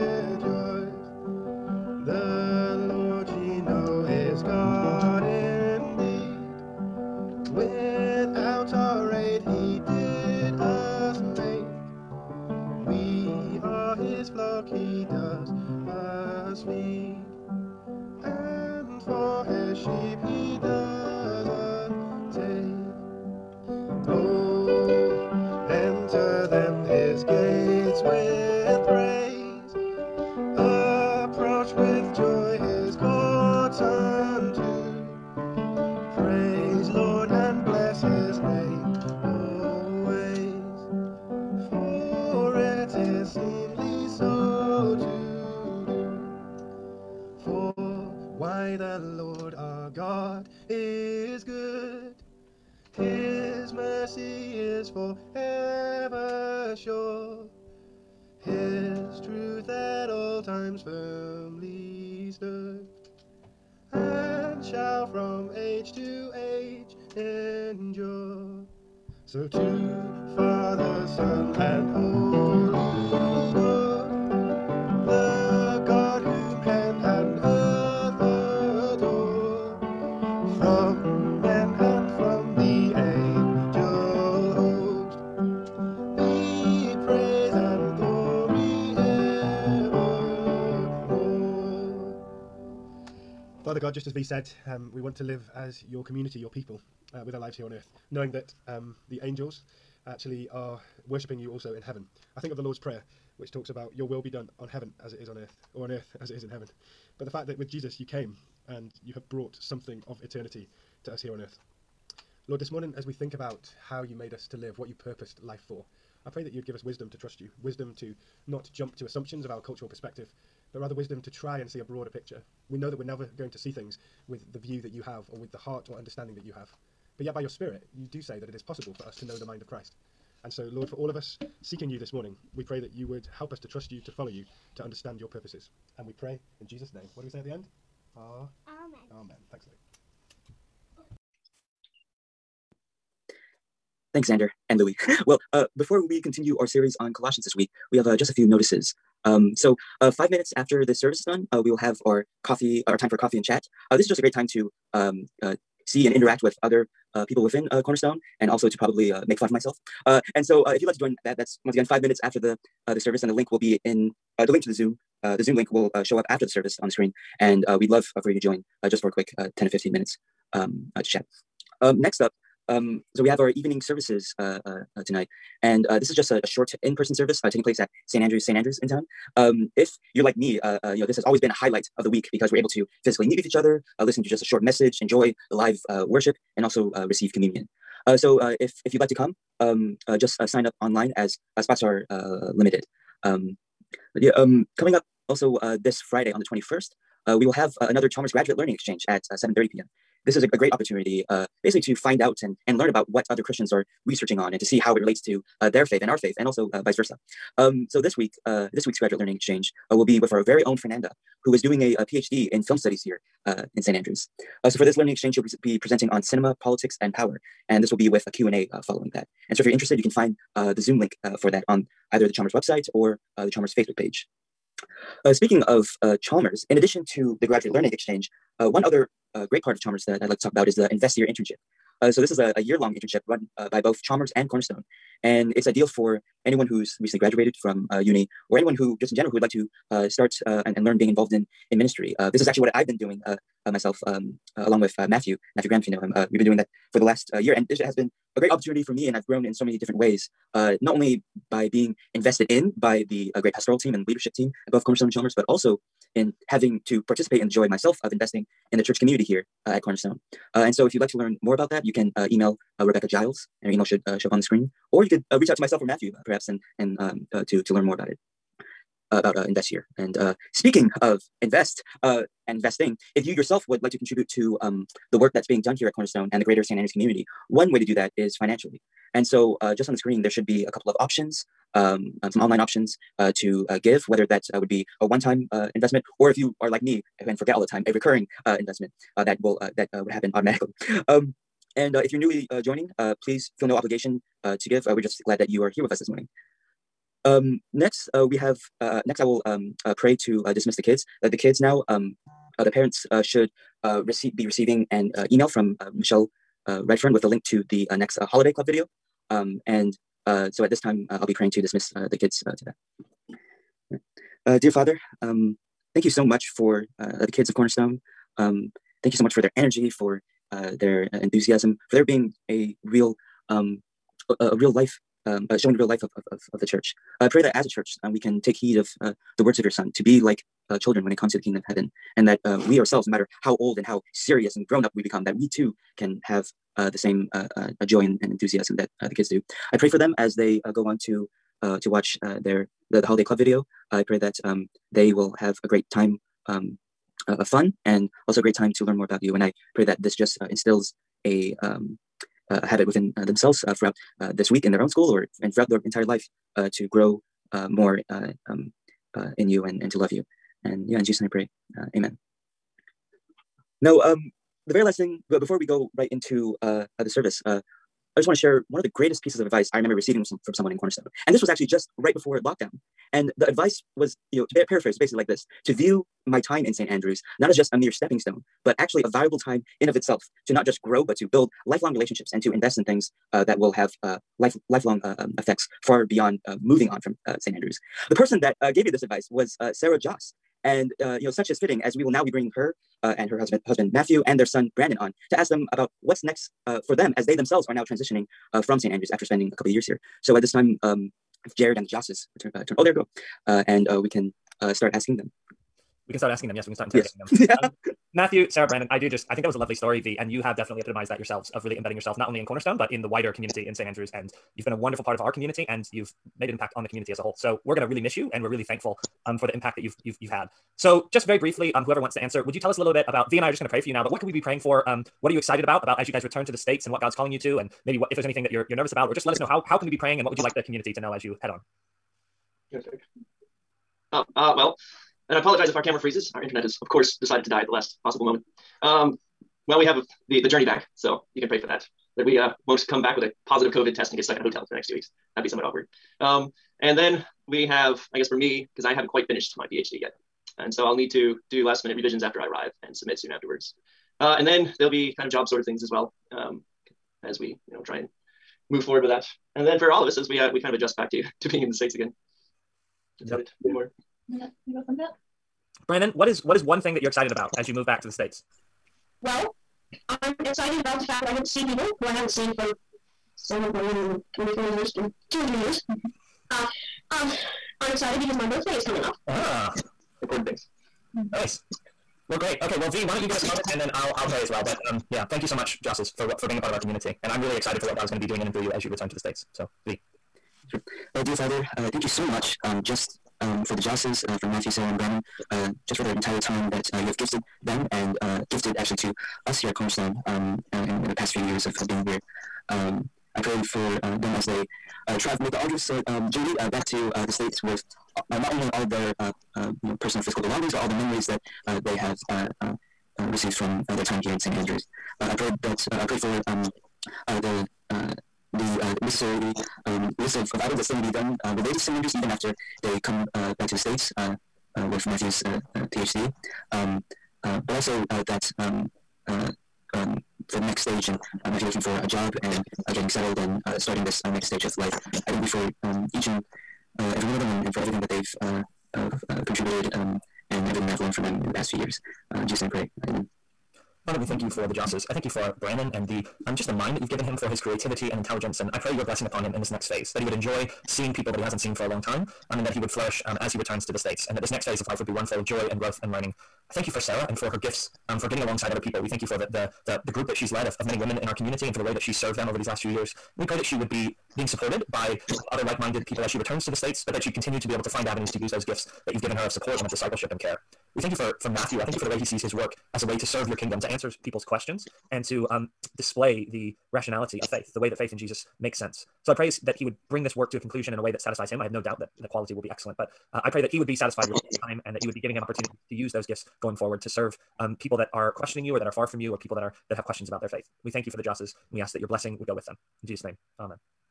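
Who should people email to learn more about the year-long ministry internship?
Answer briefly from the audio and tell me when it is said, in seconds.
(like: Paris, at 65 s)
Rebecca Giles, at 262 s.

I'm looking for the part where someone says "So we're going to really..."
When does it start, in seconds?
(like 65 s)
417 s.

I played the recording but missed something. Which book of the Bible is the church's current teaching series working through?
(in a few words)
Colossians.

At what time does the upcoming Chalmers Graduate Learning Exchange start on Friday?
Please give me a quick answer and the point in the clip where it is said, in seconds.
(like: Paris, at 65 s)
7.30 p.m., at 199 s.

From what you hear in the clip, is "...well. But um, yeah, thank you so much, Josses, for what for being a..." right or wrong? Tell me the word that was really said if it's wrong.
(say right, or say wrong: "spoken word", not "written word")
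right.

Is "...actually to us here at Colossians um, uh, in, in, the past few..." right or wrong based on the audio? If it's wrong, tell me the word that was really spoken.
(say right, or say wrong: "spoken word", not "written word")
wrong: "Cornerstone", not "Colossians".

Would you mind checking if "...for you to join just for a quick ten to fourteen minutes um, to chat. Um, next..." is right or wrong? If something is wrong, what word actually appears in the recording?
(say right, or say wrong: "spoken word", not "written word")
wrong: "fifteen", not "fourteen".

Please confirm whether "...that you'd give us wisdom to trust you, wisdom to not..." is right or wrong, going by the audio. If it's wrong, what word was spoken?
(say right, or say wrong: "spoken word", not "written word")
right.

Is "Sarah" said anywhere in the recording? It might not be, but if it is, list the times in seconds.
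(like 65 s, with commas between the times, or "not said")
389 s, 408 s, 494 s, 556 s.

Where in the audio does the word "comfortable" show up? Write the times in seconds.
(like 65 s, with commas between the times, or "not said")
not said.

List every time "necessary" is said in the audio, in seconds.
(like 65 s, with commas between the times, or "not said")
519 s.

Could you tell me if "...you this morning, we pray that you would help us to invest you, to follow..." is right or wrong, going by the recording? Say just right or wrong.
wrong.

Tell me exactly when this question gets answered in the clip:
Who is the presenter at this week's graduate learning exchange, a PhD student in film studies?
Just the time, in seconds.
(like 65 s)
210 s.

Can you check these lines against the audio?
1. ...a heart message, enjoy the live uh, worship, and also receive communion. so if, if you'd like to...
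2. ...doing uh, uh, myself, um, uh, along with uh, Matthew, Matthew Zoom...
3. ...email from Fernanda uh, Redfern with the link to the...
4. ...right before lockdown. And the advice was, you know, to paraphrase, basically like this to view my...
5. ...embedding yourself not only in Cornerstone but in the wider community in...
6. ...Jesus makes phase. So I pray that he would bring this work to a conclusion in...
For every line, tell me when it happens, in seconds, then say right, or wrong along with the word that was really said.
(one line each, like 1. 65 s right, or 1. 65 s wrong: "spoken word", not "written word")
1. 184 s wrong: "short", not "heart"
2. 242 s wrong: "Graham", not "Zoom"
3. 305 s wrong: "Michelle", not "Fernanda"
4. 371 s right
5. 411 s right
6. 578 s wrong: "sense", not "phase".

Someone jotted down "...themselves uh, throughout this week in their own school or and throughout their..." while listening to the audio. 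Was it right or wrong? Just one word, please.
right.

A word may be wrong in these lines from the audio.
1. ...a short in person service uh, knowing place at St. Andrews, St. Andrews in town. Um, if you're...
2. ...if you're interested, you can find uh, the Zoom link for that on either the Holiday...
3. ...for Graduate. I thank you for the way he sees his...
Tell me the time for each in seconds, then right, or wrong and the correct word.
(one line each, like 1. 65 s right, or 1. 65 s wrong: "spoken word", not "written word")
1. 176 s wrong: "taking", not "knowing"
2. 219 s wrong: "Chalmers", not "Holiday"
3. 571 s wrong: "Matthew", not "Graduate".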